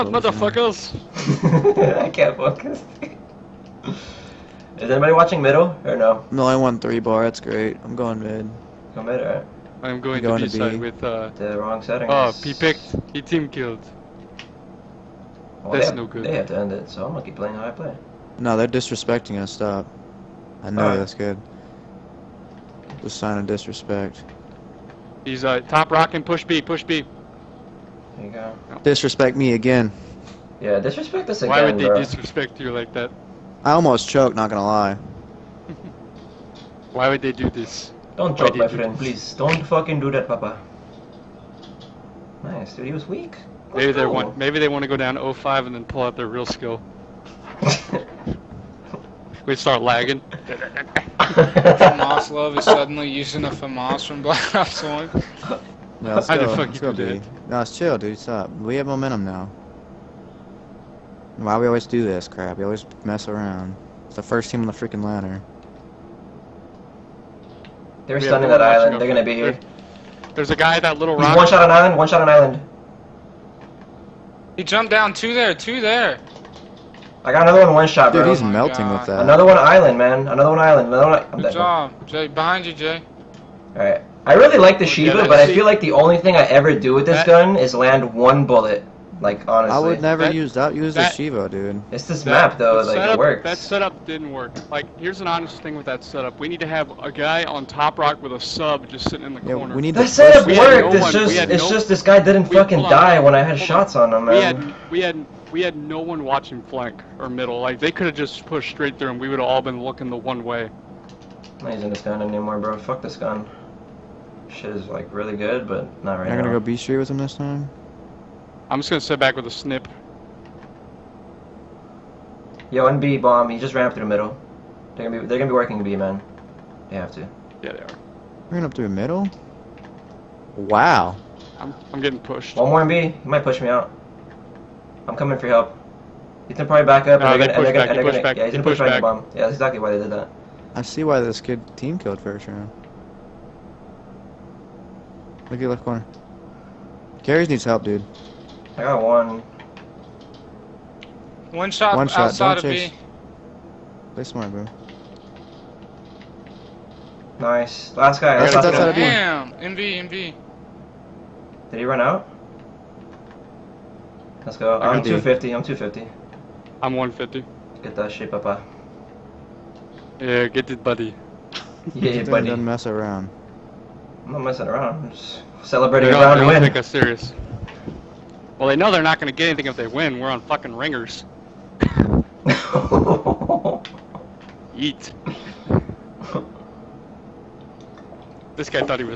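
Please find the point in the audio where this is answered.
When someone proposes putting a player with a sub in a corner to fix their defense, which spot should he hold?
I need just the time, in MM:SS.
01:37.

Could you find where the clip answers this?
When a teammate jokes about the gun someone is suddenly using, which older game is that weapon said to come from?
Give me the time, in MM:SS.
00:54.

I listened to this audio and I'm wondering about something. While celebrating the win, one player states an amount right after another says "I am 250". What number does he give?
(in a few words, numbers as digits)
150.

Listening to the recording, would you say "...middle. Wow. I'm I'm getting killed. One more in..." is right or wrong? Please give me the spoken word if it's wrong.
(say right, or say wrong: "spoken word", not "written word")
wrong: "pushed", not "killed".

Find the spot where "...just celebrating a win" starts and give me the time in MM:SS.
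02:55.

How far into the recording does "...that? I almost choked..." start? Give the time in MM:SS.
00:32.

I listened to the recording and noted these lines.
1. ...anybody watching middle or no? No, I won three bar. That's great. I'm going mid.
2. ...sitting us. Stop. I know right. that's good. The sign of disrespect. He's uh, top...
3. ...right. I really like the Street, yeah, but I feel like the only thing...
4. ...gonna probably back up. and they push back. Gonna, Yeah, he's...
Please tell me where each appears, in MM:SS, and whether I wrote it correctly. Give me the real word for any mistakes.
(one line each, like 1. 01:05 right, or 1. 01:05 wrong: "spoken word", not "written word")
1. 00:04 right
2. 00:18 wrong: "disrespecting", not "sitting"
3. 01:23 wrong: "Shiva", not "Street"
4. 02:16 right.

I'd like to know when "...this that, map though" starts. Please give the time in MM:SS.
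01:32.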